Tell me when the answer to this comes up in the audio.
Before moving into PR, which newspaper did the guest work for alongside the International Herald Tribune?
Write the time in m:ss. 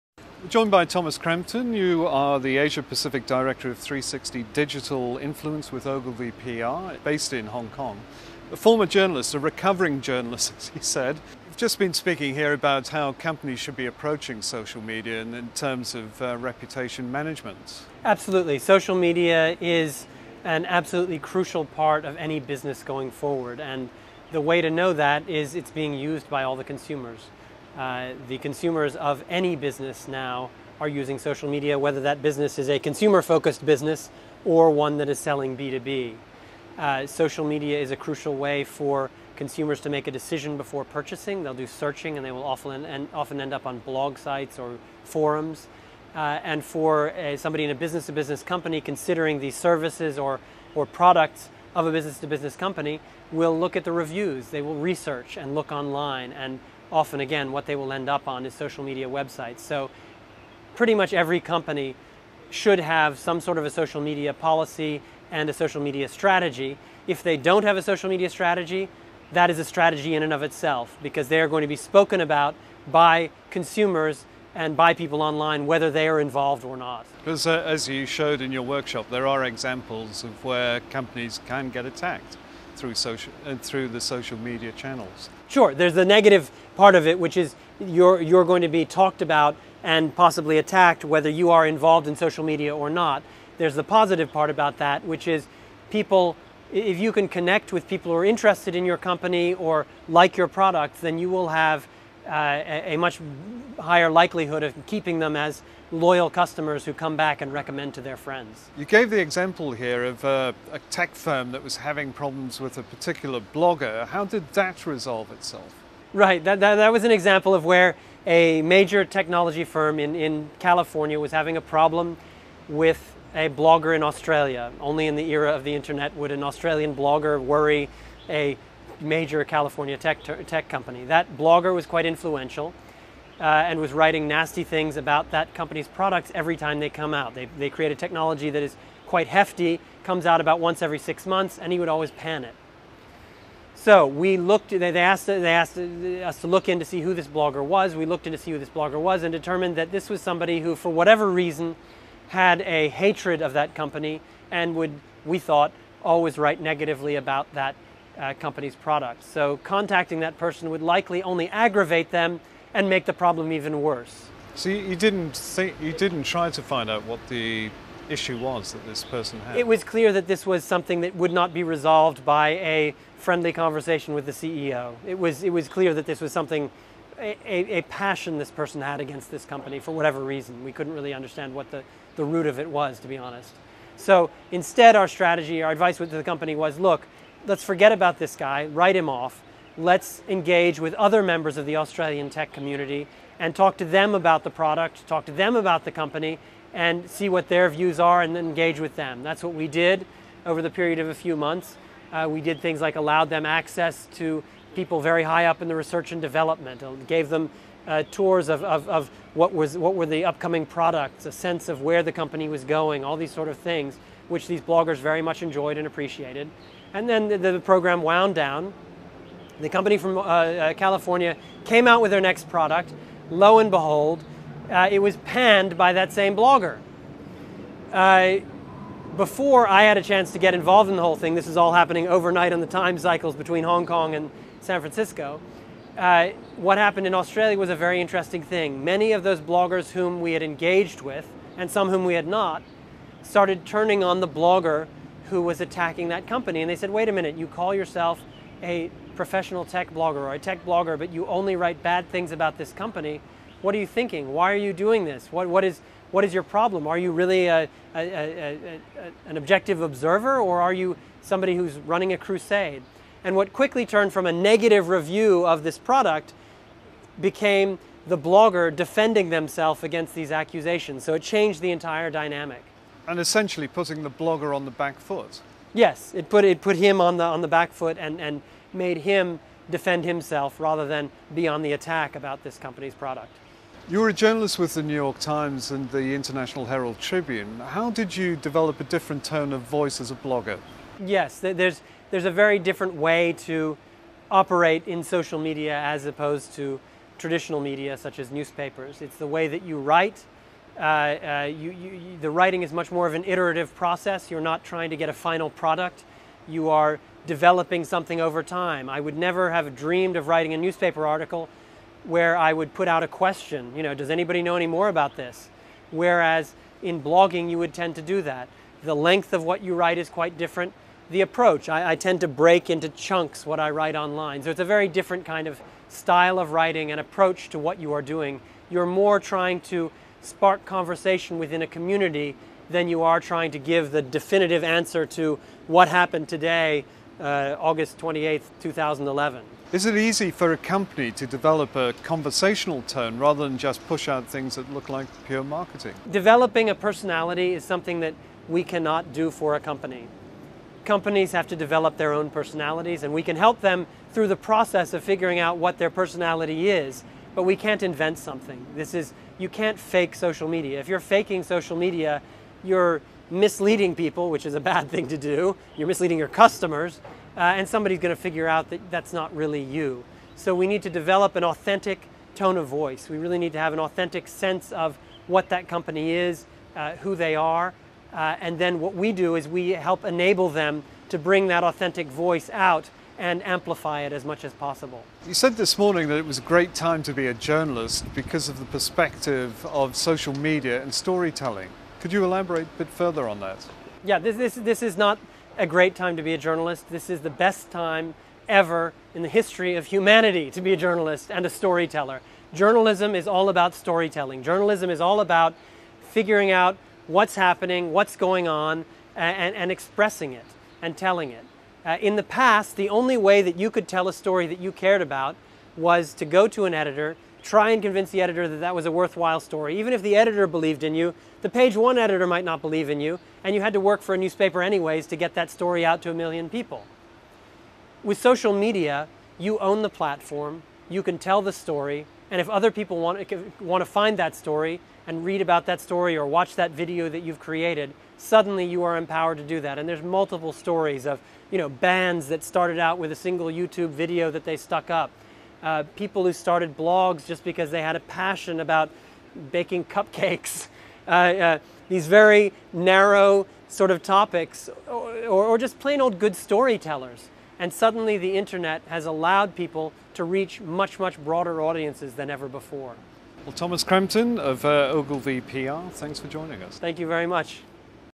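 4:44.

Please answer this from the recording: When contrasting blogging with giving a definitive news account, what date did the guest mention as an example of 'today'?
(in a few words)
August 28th, 2011.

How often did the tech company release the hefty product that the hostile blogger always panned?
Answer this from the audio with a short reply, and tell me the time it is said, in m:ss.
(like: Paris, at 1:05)
once every six months, at 2:20.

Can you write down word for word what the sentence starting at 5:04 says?
You're not trying to get a final product.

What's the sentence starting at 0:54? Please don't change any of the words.
They will research and look online and often again what they will end up on is social media websites.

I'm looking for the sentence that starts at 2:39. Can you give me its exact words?
So contacting that person would likely only aggravate them and make the problem even worse.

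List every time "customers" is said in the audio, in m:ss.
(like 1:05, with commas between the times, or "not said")
1:46, 6:06.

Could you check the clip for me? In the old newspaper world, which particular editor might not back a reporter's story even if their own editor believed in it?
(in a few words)
the page one editor.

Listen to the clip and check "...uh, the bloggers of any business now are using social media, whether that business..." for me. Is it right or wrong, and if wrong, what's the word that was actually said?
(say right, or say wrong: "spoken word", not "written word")
wrong: "consumers", not "bloggers".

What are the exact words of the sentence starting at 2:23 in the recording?
So we looked, they asked, they asked us to look in to see who this blogger was.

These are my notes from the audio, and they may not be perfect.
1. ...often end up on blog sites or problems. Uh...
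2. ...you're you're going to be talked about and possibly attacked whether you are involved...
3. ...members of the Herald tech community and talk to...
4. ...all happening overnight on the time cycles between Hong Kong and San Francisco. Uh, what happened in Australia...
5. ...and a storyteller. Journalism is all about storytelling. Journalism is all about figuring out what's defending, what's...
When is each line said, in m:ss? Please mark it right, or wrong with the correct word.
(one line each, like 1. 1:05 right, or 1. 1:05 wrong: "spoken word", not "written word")
1. 0:43 wrong: "forums", not "problems"
2. 1:27 right
3. 3:11 wrong: "Australian", not "Herald"
4. 3:51 right
5. 6:41 wrong: "happening", not "defending".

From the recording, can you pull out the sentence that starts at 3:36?
And then the, the program wound down.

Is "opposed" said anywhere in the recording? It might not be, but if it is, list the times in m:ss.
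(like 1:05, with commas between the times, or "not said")
4:56.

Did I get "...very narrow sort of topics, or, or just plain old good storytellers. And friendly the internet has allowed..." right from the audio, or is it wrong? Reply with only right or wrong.
wrong.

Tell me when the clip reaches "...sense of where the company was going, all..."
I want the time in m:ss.
3:31.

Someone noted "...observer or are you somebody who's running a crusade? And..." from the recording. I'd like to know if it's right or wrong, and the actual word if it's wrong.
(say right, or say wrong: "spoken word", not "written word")
right.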